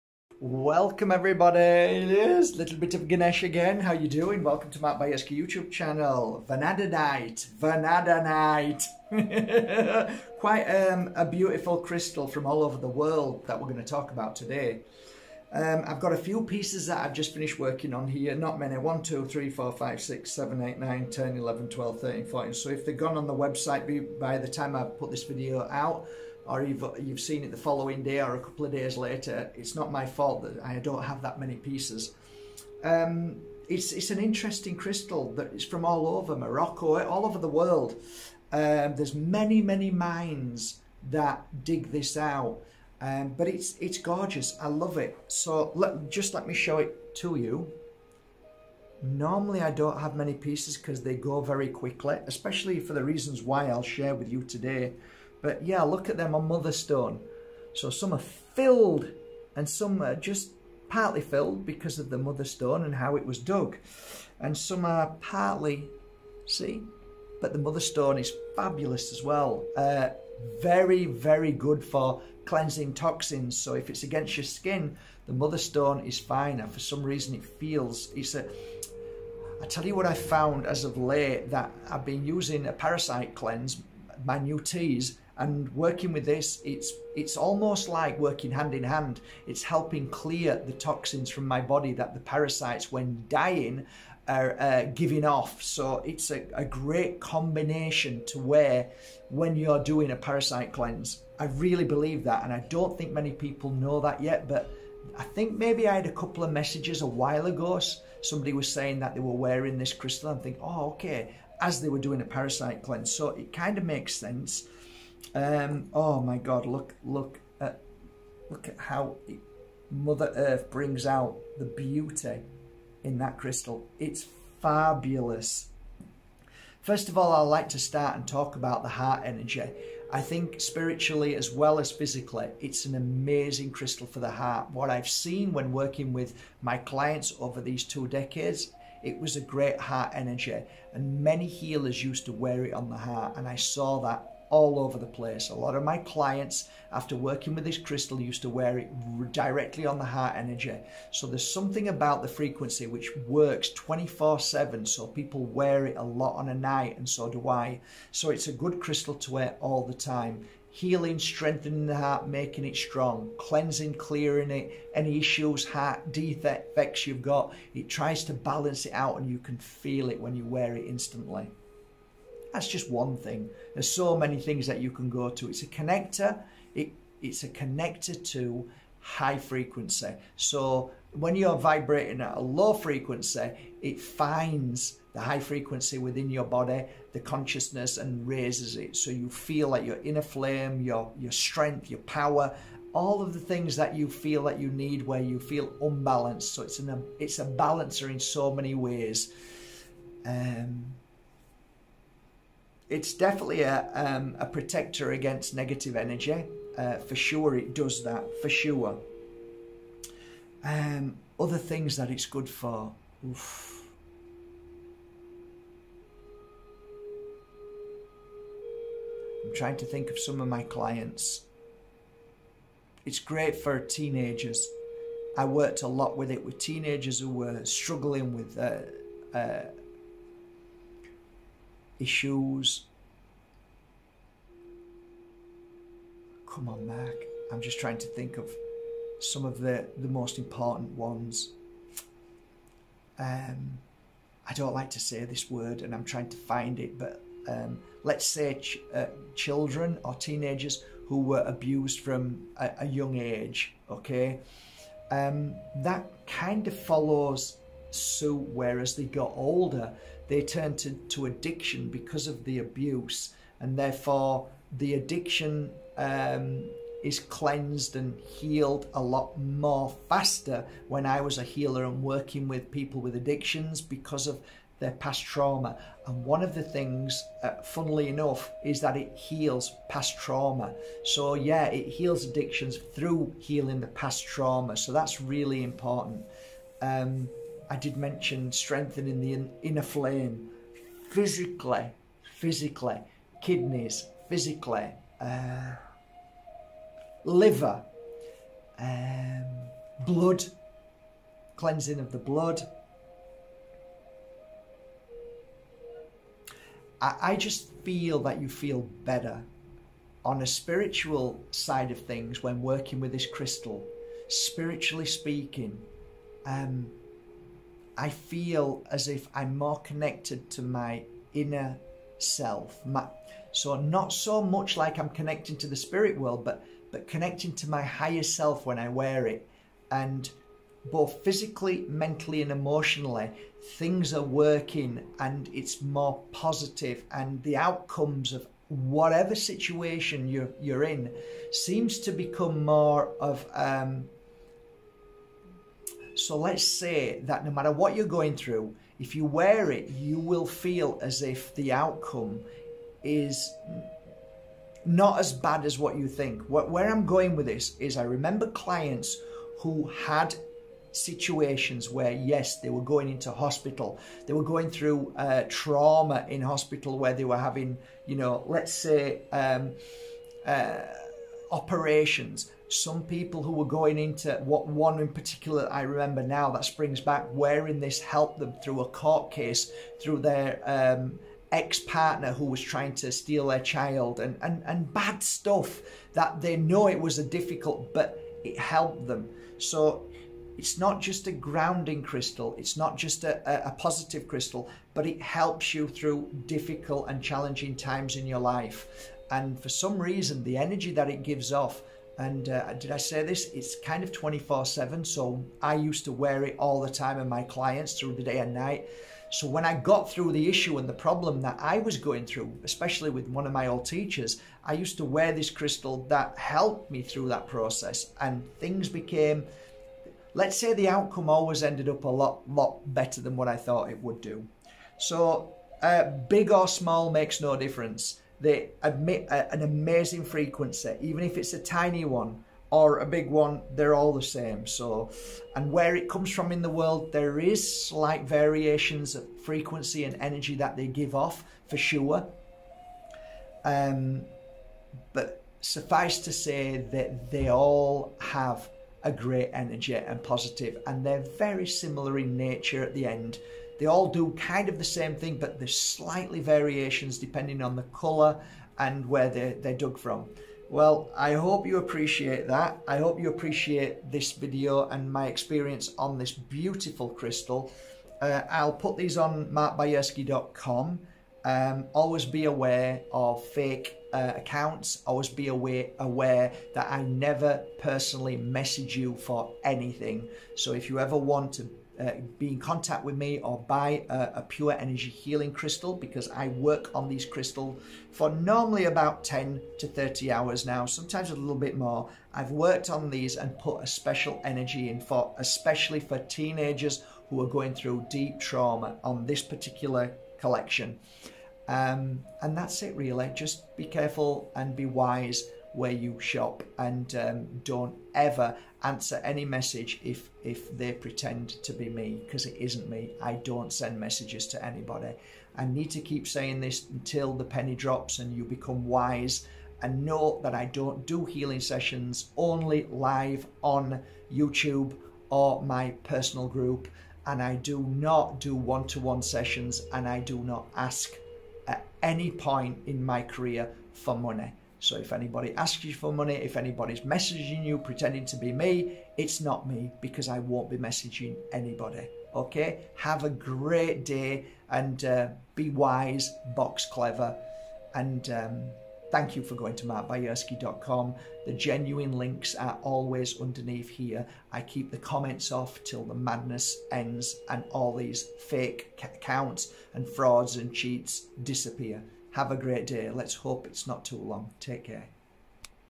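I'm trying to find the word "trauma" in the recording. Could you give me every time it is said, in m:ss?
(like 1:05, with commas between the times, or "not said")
4:35, 4:40, 4:44, 6:05, 8:18.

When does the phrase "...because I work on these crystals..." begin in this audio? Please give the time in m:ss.
8:05.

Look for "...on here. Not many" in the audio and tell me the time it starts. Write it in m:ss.
0:17.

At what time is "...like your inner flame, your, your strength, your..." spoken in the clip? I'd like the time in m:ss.
3:09.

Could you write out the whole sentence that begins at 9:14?
I keep the comments off till the madness ends and all these fake accounts and frauds and cheats disappear.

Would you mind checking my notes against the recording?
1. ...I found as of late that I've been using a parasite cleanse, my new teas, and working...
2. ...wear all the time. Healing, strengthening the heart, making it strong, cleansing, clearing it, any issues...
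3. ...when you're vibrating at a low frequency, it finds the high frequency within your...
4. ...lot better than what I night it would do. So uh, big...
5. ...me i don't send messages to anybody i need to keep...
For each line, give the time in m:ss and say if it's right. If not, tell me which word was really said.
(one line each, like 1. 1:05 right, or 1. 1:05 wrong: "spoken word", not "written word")
1. 1:20 right
2. 2:39 right
3. 3:01 right
4. 7:02 wrong: "thought", not "night"
5. 8:32 right.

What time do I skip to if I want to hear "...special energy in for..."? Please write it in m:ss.
8:13.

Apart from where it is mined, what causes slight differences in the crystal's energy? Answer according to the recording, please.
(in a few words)
colour.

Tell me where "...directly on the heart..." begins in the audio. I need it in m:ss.
2:29.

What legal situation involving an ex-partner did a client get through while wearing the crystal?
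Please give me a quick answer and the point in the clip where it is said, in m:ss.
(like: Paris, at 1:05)
court case, at 6:18.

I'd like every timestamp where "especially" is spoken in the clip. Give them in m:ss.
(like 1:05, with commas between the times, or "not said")
0:52, 6:52, 8:15.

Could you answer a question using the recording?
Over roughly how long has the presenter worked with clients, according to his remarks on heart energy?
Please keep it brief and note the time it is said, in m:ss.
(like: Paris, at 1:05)
two decades, at 2:17.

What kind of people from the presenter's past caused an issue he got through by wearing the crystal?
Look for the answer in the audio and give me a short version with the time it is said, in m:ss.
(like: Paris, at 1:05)
old teachers, at 6:53.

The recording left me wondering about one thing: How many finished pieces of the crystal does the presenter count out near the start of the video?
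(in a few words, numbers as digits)
14.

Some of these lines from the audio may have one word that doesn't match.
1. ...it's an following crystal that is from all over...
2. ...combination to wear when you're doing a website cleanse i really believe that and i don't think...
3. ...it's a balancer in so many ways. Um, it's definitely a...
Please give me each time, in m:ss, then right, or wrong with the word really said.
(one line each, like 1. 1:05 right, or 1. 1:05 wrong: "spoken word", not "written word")
1. 0:33 wrong: "interesting", not "following"
2. 1:37 wrong: "parasite", not "website"
3. 3:17 right.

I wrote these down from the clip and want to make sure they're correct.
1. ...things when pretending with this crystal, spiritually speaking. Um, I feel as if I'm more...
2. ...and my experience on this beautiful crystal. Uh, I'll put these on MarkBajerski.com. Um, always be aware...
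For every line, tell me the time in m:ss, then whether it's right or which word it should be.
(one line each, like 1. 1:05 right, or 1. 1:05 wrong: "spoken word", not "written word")
1. 5:12 wrong: "working", not "pretending"
2. 7:44 right.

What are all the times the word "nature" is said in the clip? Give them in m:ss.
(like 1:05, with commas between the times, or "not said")
7:32.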